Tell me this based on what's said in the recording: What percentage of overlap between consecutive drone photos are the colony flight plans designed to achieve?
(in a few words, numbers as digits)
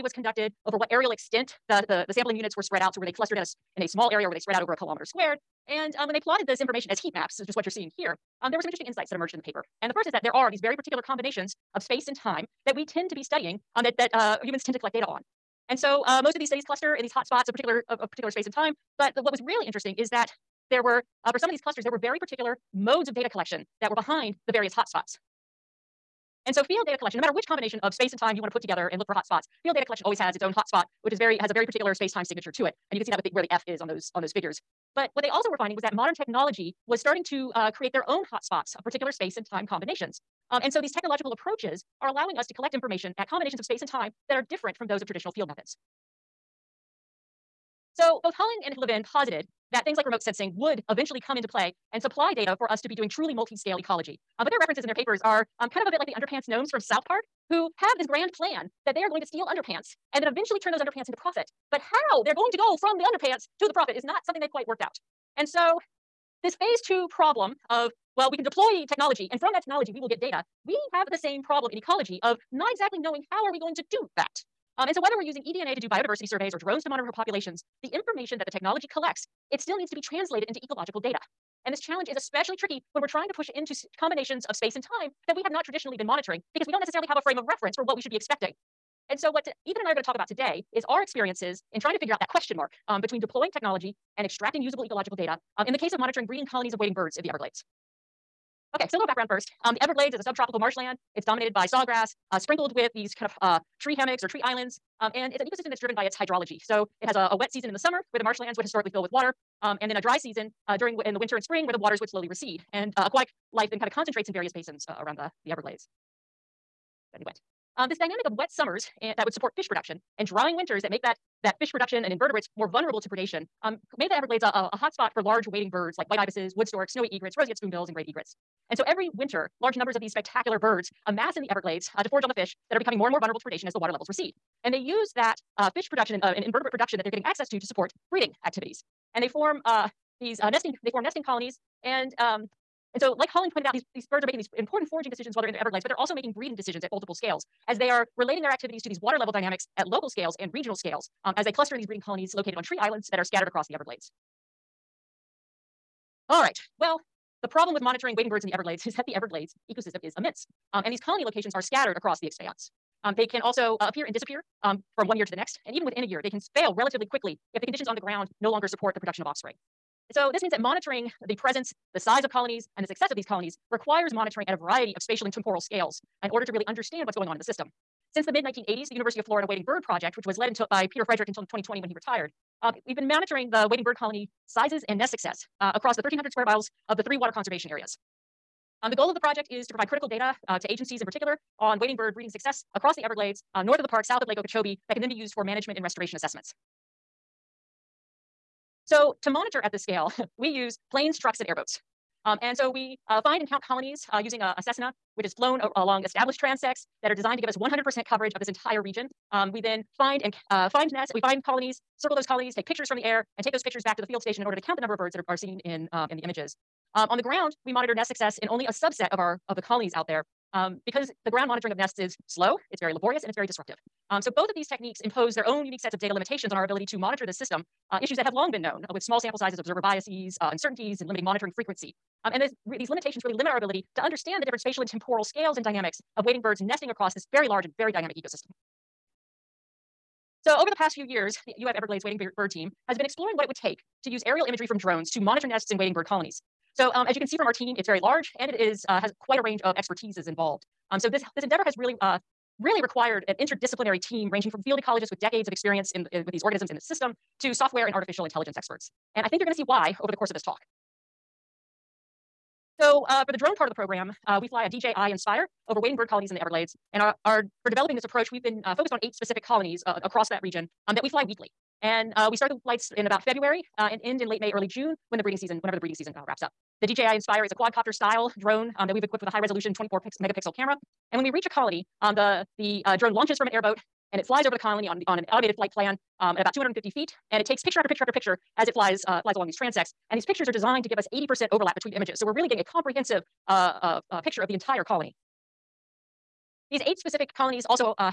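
80%.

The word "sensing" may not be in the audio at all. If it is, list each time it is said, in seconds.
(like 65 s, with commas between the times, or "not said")
50 s.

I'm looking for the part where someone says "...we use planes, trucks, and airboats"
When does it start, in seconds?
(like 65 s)
200 s.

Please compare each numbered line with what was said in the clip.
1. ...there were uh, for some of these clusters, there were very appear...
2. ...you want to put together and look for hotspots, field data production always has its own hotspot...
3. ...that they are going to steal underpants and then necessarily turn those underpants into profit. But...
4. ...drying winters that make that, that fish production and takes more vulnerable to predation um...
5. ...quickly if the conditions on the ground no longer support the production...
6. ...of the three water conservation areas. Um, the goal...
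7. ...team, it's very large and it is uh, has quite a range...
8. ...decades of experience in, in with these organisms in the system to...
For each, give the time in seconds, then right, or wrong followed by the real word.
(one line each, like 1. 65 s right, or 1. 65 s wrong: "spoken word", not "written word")
1. 20 s wrong: "particular", not "appear"
2. 28 s wrong: "collection", not "production"
3. 58 s wrong: "eventually", not "necessarily"
4. 120 s wrong: "invertebrates", not "takes"
5. 167 s right
6. 186 s right
7. 247 s right
8. 255 s right.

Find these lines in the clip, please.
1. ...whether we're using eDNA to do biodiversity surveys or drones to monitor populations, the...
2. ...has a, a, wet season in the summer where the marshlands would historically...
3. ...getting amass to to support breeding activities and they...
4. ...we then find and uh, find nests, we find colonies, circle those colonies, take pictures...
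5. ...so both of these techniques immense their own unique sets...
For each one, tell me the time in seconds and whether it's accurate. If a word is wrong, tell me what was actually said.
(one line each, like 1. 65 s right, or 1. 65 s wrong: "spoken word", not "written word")
1. 74 s right
2. 107 s right
3. 137 s wrong: "access", not "amass"
4. 209 s right
5. 224 s wrong: "impose", not "immense".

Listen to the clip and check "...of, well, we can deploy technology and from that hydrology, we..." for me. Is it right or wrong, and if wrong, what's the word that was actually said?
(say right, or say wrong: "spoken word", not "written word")
wrong: "technology", not "hydrology".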